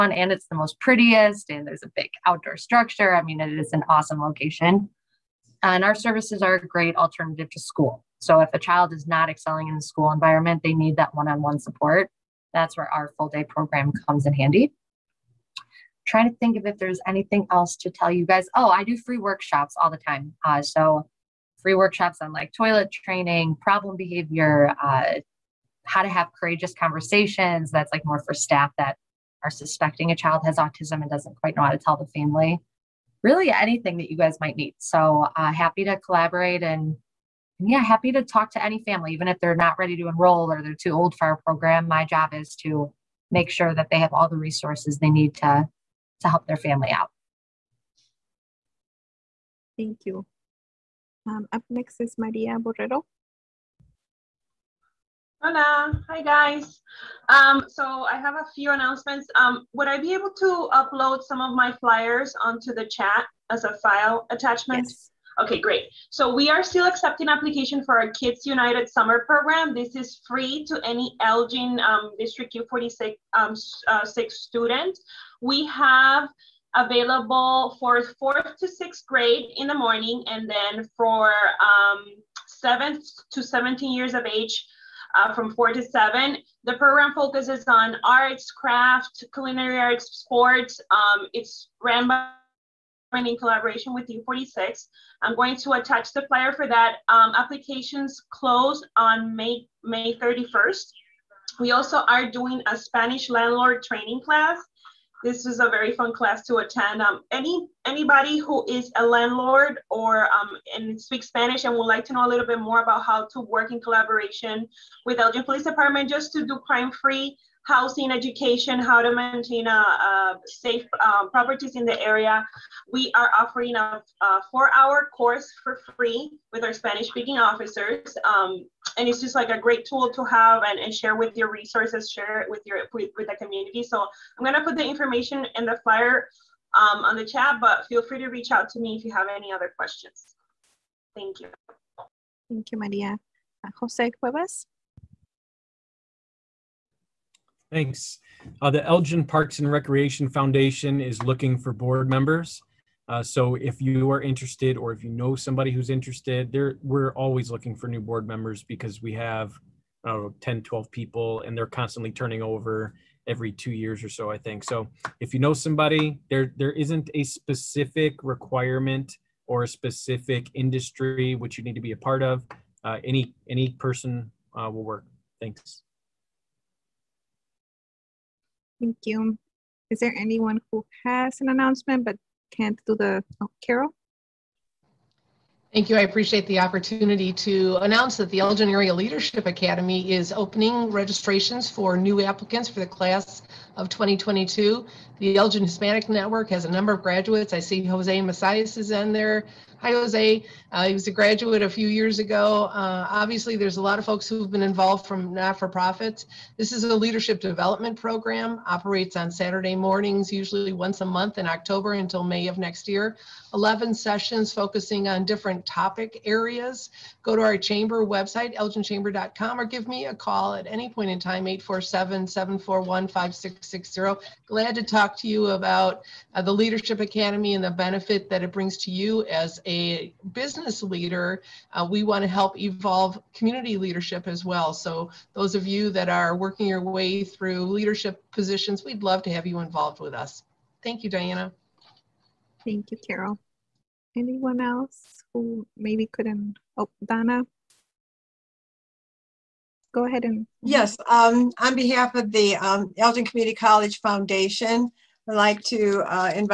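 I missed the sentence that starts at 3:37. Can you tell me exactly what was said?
Go to our chamber website, elginchamber.com, or give me a call at any point in time, 847-741-5660.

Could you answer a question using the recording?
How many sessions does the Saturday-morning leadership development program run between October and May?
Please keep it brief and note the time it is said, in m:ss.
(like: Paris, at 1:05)
11, at 3:33.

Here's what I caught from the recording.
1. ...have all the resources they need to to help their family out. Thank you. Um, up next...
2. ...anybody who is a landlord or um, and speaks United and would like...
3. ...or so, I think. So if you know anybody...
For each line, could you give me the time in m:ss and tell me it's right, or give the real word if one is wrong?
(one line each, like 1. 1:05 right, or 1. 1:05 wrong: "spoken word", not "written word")
1. 0:43 right
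2. 1:47 wrong: "Spanish", not "United"
3. 2:44 wrong: "somebody", not "anybody".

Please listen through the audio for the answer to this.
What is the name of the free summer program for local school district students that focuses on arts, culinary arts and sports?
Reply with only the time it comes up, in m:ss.
1:08.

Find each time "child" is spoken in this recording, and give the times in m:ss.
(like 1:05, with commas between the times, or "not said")
0:08, 0:30.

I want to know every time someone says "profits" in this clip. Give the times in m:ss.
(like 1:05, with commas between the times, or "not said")
3:25.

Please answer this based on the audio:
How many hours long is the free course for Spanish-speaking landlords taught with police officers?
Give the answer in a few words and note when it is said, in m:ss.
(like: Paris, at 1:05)
4, at 2:04.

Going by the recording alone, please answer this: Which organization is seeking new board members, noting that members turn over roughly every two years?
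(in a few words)
Elgin Parks and Recreation Foundation.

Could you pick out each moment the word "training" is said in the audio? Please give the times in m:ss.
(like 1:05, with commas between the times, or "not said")
0:22, 1:43.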